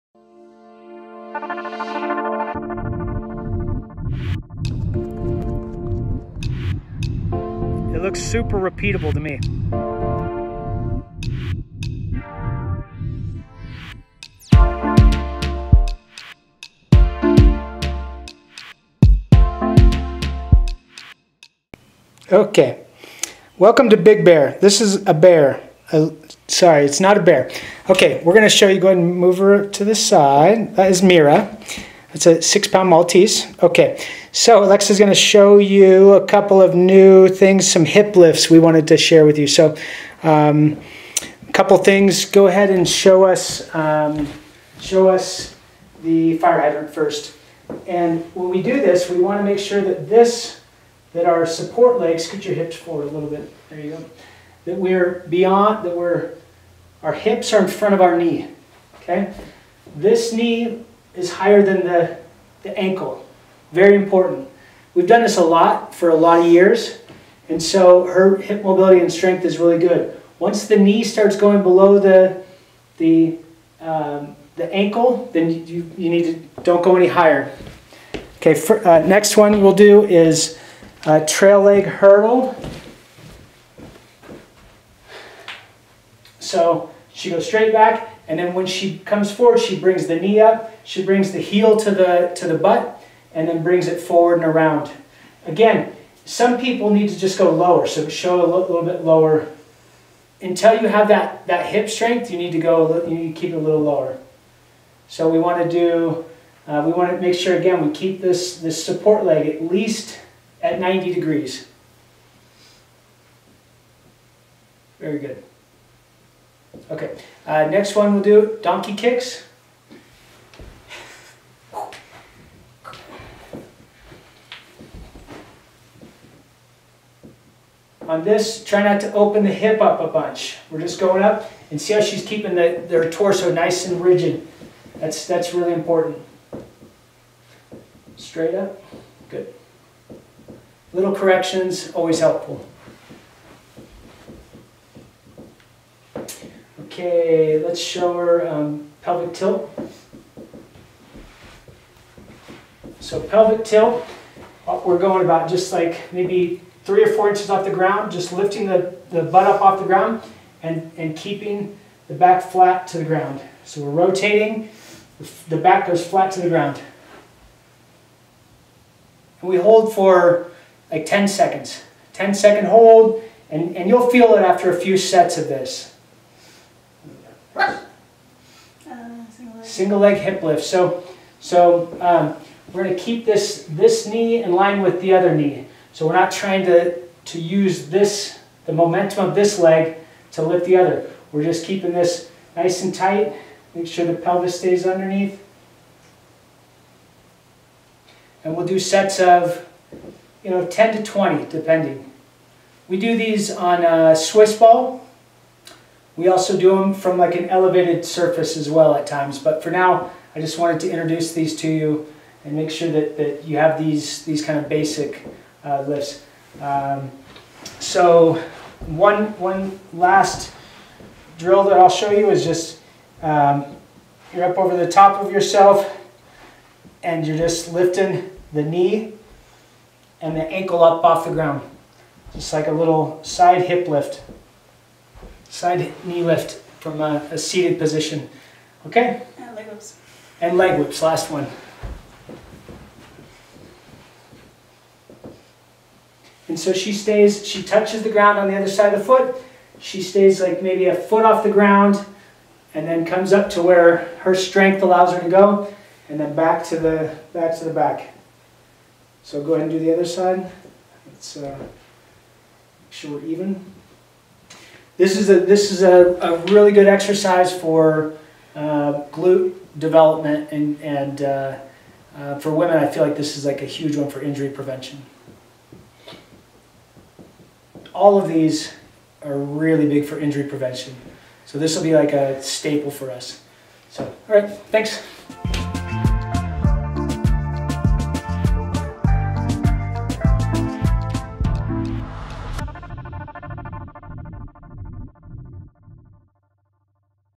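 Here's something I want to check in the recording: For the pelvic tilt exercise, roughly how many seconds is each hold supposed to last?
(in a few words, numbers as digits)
10 seconds.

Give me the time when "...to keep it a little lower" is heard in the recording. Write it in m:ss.
1:43.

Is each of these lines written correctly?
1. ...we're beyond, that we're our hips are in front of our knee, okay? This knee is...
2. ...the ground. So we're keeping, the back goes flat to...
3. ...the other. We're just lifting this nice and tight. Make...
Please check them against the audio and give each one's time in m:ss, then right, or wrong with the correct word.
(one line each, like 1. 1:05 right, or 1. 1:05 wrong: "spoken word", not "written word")
1. 0:54 right
2. 2:42 wrong: "rotating", not "keeping"
3. 3:10 wrong: "keeping", not "lifting".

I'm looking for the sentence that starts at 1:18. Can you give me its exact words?
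Okay, for, uh, next one we'll do is a trail leg hurdle.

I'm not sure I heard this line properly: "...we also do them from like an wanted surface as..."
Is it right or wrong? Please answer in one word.
wrong.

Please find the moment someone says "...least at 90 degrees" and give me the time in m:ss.
1:49.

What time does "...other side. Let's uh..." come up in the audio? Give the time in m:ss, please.
4:19.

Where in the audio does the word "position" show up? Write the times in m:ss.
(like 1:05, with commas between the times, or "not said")
3:57.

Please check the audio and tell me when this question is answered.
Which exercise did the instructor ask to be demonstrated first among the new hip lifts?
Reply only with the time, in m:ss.
0:46.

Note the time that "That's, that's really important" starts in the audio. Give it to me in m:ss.
2:14.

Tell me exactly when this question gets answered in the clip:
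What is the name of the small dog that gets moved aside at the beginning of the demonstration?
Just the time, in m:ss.
0:31.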